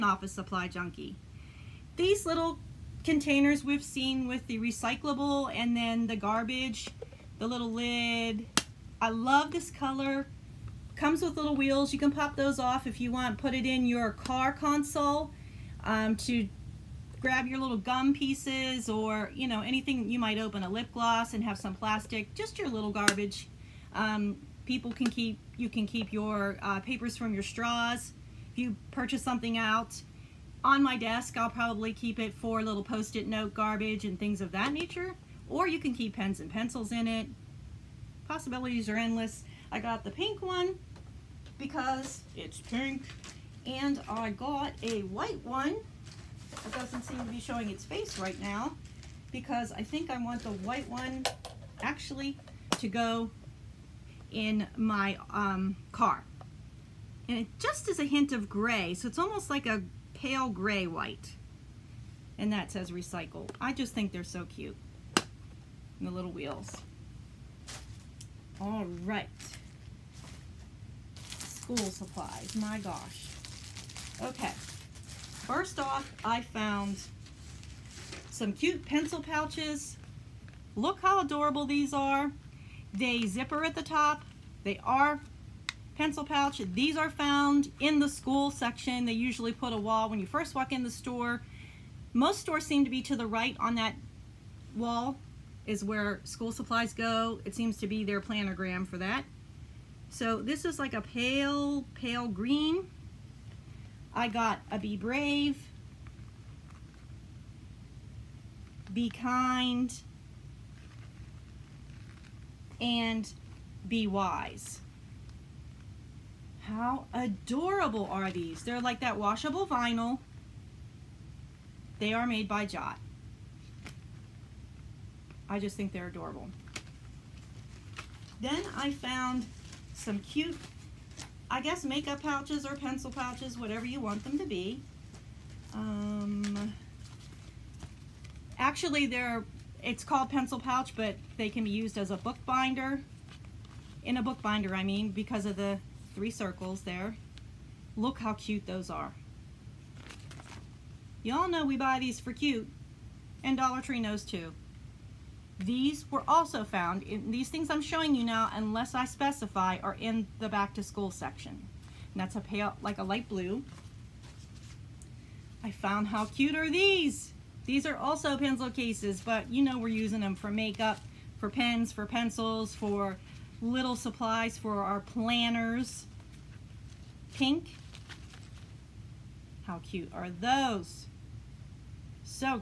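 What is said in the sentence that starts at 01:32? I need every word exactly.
Most stores seem to be to the right on that wall is where school supplies go.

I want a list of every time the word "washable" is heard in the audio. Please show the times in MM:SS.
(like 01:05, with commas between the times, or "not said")
01:59.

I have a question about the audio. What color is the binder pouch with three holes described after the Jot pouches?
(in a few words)
Light blue.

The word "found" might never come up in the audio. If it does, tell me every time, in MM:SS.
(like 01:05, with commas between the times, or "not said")
01:16, 01:27, 02:08, 02:36, 02:45.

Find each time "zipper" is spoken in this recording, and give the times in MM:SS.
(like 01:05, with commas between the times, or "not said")
01:23.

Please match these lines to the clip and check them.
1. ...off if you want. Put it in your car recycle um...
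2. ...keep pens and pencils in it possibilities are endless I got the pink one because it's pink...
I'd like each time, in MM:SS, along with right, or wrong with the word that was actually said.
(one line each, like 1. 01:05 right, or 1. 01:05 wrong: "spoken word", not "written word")
1. 00:12 wrong: "console", not "recycle"
2. 00:35 right.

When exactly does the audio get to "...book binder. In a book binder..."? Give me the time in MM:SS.
02:22.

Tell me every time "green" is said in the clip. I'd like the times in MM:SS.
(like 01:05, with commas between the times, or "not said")
01:42.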